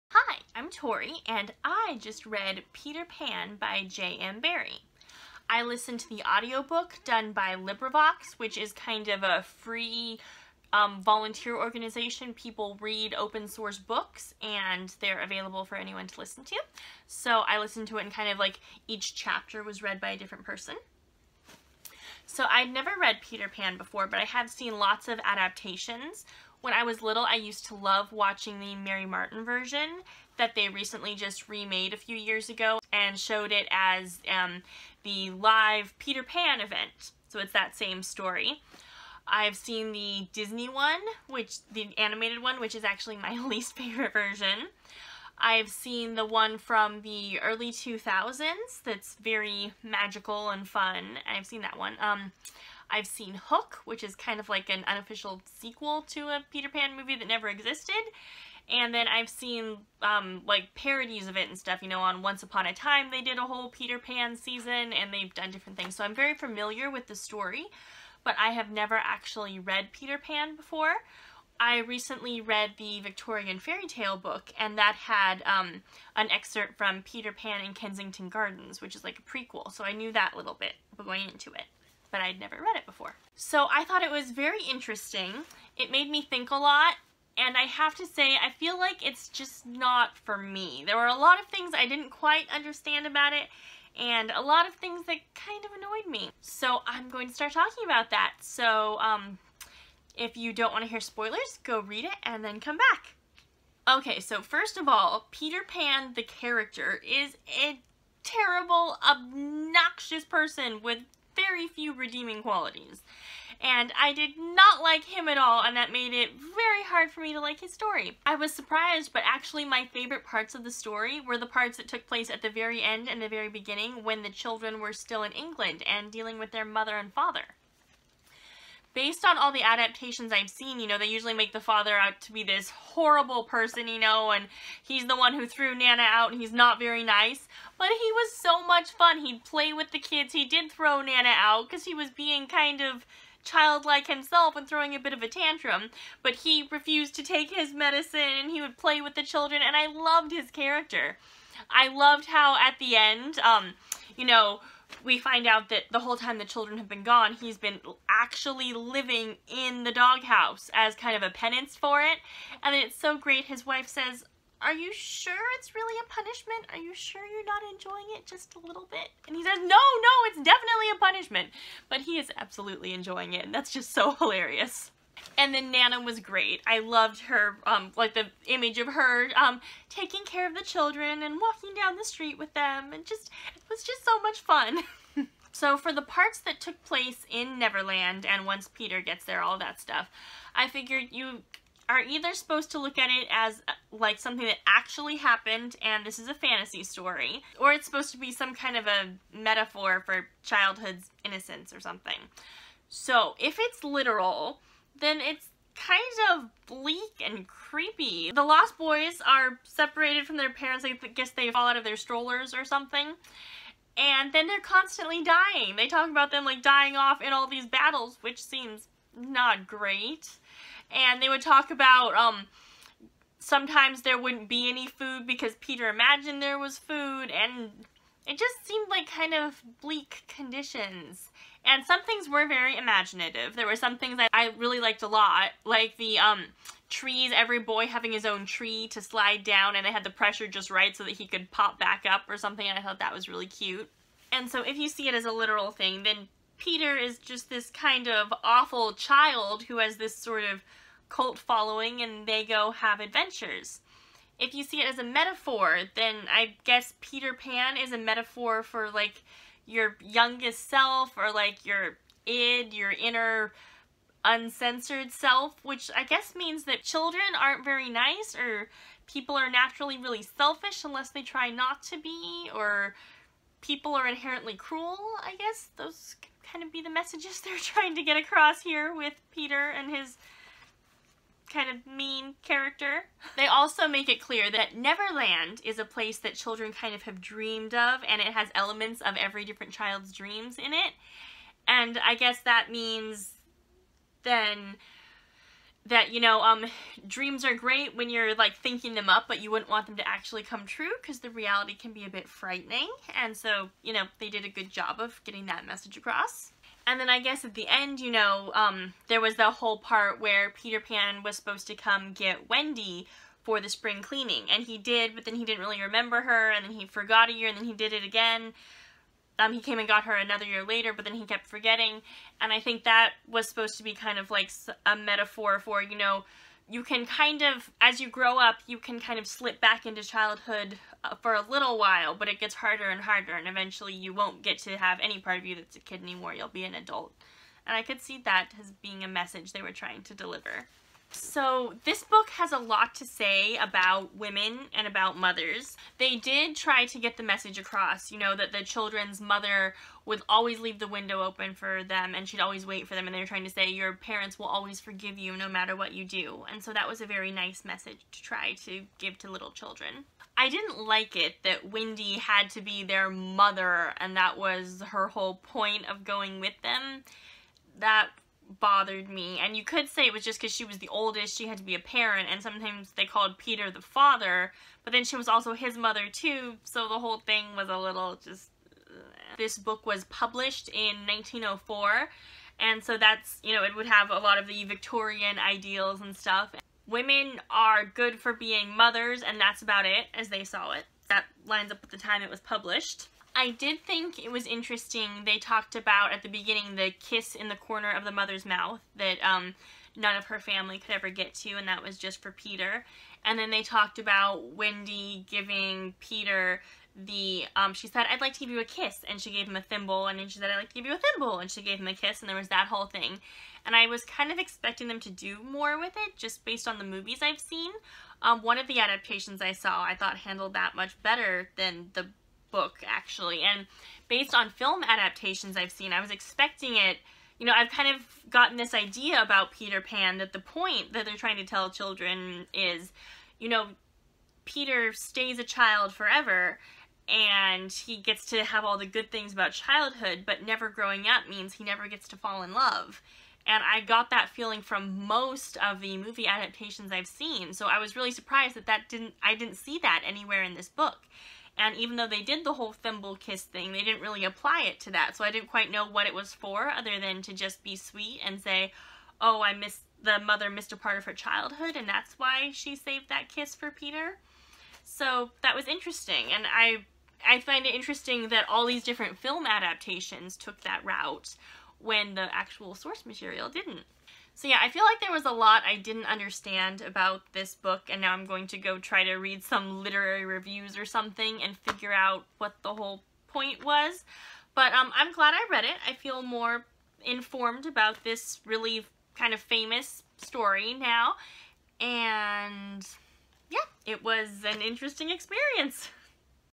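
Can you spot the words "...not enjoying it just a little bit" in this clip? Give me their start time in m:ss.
2:47.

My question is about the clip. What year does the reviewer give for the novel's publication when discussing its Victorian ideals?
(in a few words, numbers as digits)
1904.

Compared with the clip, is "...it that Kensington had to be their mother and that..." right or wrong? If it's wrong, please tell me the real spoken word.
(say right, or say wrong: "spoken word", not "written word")
wrong: "Wendy", not "Kensington".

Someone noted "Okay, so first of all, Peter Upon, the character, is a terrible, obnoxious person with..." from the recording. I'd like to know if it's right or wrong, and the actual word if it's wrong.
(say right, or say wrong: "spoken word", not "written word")
wrong: "Pan", not "Upon".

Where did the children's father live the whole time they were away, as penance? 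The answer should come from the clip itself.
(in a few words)
The doghouse.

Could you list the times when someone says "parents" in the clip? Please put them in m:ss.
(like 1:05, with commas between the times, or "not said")
3:30, 5:53, 6:11.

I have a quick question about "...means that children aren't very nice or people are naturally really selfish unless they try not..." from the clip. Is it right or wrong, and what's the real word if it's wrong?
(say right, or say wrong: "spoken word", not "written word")
right.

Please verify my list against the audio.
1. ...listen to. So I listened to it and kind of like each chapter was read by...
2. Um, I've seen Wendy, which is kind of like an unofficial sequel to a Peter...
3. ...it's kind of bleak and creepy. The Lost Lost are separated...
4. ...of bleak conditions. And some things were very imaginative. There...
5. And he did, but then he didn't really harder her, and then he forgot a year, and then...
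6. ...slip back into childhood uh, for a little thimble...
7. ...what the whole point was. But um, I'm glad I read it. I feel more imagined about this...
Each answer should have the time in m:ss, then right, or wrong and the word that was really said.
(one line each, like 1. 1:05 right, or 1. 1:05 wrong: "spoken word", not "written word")
1. 0:16 right
2. 0:51 wrong: "Hook", not "Wendy"
3. 3:25 wrong: "Boys", not "Lost"
4. 3:49 right
5. 5:14 wrong: "remember", not "harder"
6. 5:29 wrong: "while", not "thimble"
7. 8:02 wrong: "informed", not "imagined".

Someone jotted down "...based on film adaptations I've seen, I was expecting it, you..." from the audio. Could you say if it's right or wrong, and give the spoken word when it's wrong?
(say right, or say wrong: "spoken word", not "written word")
right.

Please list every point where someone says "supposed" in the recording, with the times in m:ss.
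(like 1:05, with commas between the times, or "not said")
3:12, 3:17, 5:11, 5:23.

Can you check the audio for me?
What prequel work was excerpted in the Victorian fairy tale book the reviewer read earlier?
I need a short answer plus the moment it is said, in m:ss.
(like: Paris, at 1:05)
Peter Pan in Kensington Gardens, at 1:17.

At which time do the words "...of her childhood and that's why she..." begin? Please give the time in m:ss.
7:40.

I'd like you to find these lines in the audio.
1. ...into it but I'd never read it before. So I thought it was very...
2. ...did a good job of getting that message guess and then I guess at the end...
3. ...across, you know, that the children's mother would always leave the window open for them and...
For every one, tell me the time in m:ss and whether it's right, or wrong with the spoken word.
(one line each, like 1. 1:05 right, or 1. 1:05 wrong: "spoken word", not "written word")
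1. 1:21 right
2. 5:04 wrong: "across", not "guess"
3. 5:47 right.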